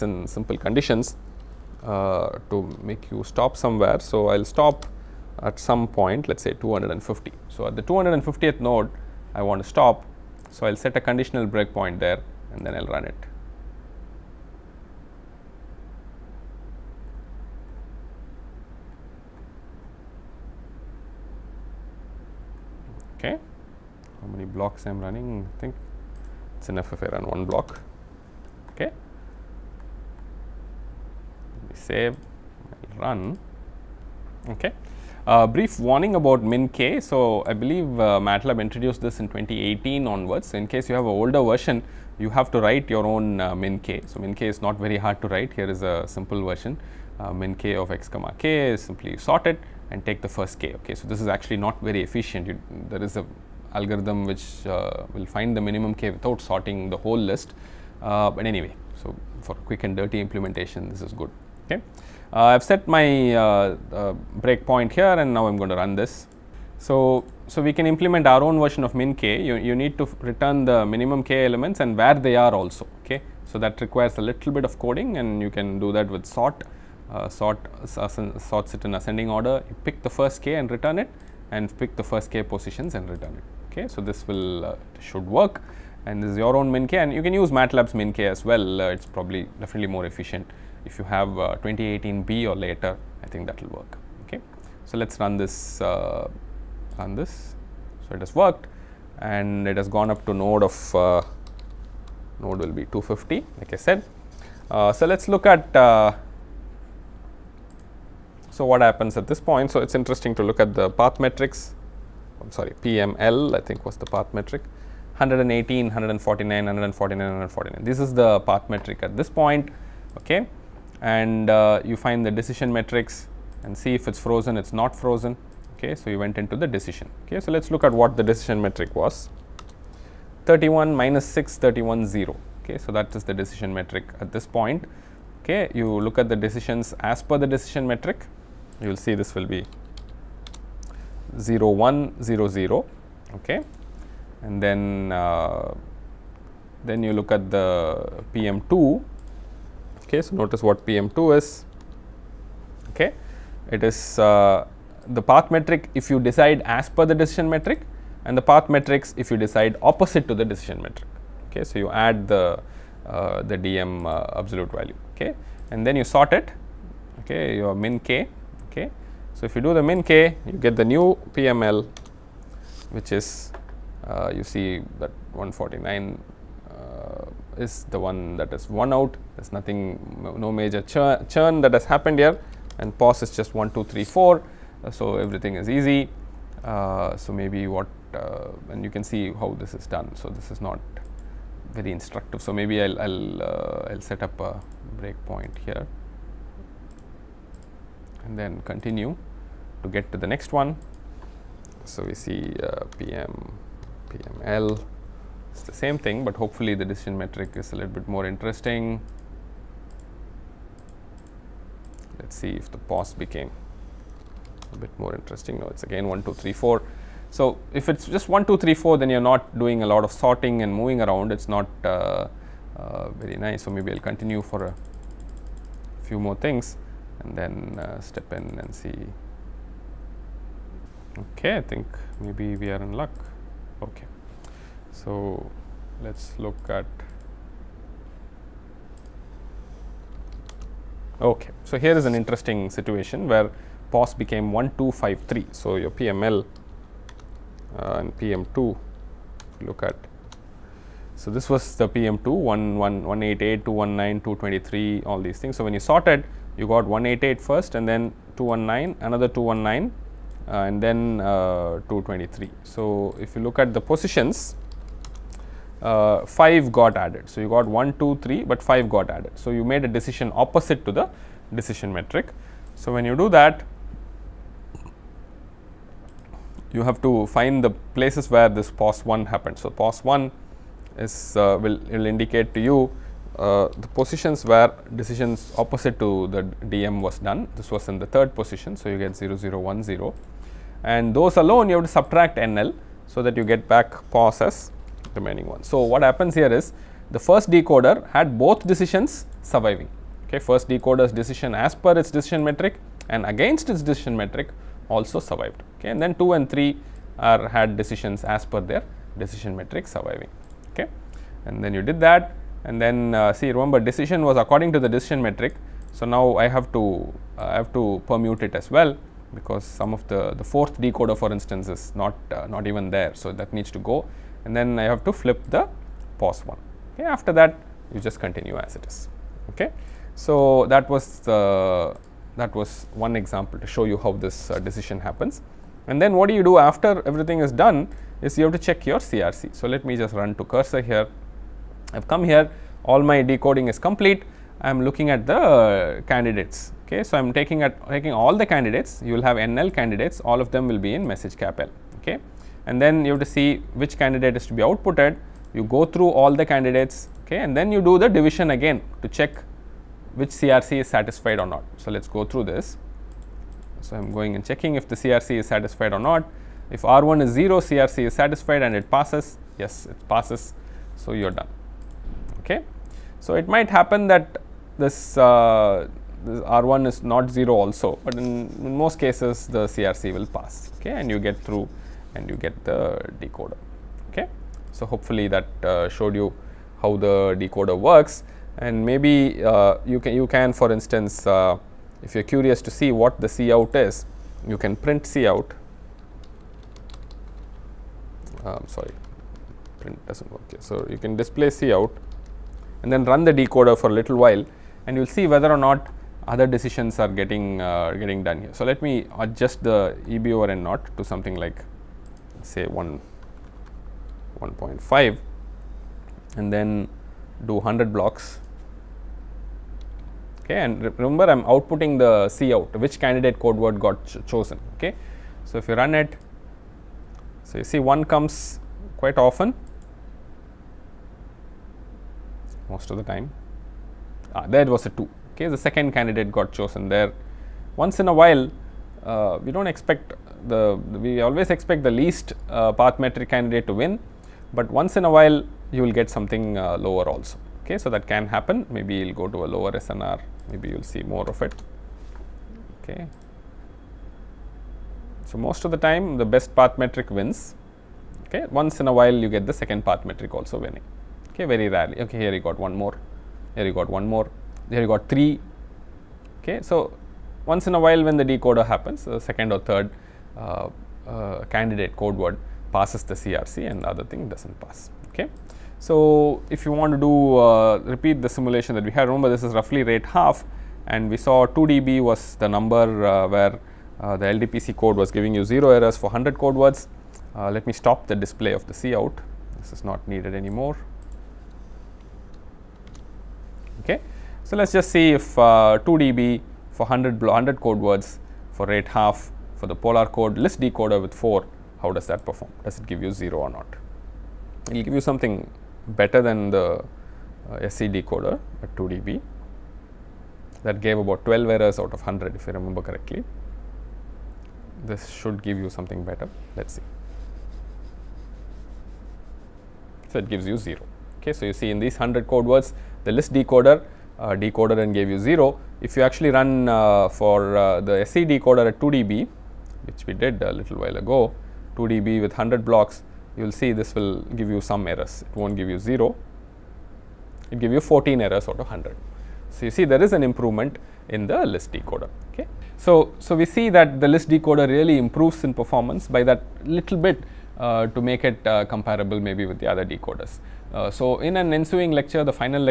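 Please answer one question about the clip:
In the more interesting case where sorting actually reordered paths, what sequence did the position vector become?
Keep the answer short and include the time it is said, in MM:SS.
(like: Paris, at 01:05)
1253, at 04:04.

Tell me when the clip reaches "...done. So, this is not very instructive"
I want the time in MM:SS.
03:09.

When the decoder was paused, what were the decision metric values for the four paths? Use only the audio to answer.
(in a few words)
31, -6, 31, 0.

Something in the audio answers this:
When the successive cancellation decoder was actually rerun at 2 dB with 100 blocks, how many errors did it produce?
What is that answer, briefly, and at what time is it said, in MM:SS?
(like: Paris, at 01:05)
14, at 08:57.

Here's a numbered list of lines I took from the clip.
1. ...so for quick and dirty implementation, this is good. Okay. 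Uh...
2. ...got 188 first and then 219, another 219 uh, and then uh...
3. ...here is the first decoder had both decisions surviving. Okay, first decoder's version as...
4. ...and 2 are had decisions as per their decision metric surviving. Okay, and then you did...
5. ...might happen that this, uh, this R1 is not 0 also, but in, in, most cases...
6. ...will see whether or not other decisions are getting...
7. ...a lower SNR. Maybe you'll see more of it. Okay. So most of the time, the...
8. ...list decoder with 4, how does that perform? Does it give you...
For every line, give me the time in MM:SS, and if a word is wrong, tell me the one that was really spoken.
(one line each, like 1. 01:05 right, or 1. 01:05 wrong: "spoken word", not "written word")
1. 00:59 right
2. 04:16 right
3. 04:56 wrong: "decision", not "version"
4. 05:06 wrong: "3", not "2"
5. 06:13 right
6. 06:44 right
7. 07:29 right
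8. 08:20 right.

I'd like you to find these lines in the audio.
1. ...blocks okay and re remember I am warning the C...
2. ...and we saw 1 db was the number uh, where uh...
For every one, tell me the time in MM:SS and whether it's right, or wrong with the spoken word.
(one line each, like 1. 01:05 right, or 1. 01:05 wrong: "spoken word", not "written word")
1. 06:57 wrong: "outputting", not "warning"
2. 08:00 wrong: "2", not "1".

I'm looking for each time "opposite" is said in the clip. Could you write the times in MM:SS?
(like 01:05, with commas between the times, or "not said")
02:39, 04:30, 04:45.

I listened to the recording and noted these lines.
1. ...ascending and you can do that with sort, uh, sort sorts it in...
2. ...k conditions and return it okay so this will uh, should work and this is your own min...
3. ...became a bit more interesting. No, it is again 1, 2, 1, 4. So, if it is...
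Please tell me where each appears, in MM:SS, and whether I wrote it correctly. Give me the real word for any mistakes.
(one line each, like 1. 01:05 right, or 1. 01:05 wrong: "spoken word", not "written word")
1. 01:14 wrong: "coding", not "ascending"
2. 01:22 wrong: "positions", not "conditions"
3. 03:33 wrong: "3", not "1".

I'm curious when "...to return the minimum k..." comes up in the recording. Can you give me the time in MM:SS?
01:09.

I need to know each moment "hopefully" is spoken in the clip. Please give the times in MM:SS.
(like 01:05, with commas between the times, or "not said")
03:26, 06:24.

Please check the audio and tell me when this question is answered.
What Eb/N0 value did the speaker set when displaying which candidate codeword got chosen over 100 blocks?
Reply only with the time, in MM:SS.
06:54.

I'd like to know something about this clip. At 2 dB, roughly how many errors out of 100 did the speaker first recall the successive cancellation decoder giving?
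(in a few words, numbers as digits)
12.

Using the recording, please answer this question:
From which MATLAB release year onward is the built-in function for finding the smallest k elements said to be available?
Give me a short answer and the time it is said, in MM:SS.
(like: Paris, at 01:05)
2018, at 00:39.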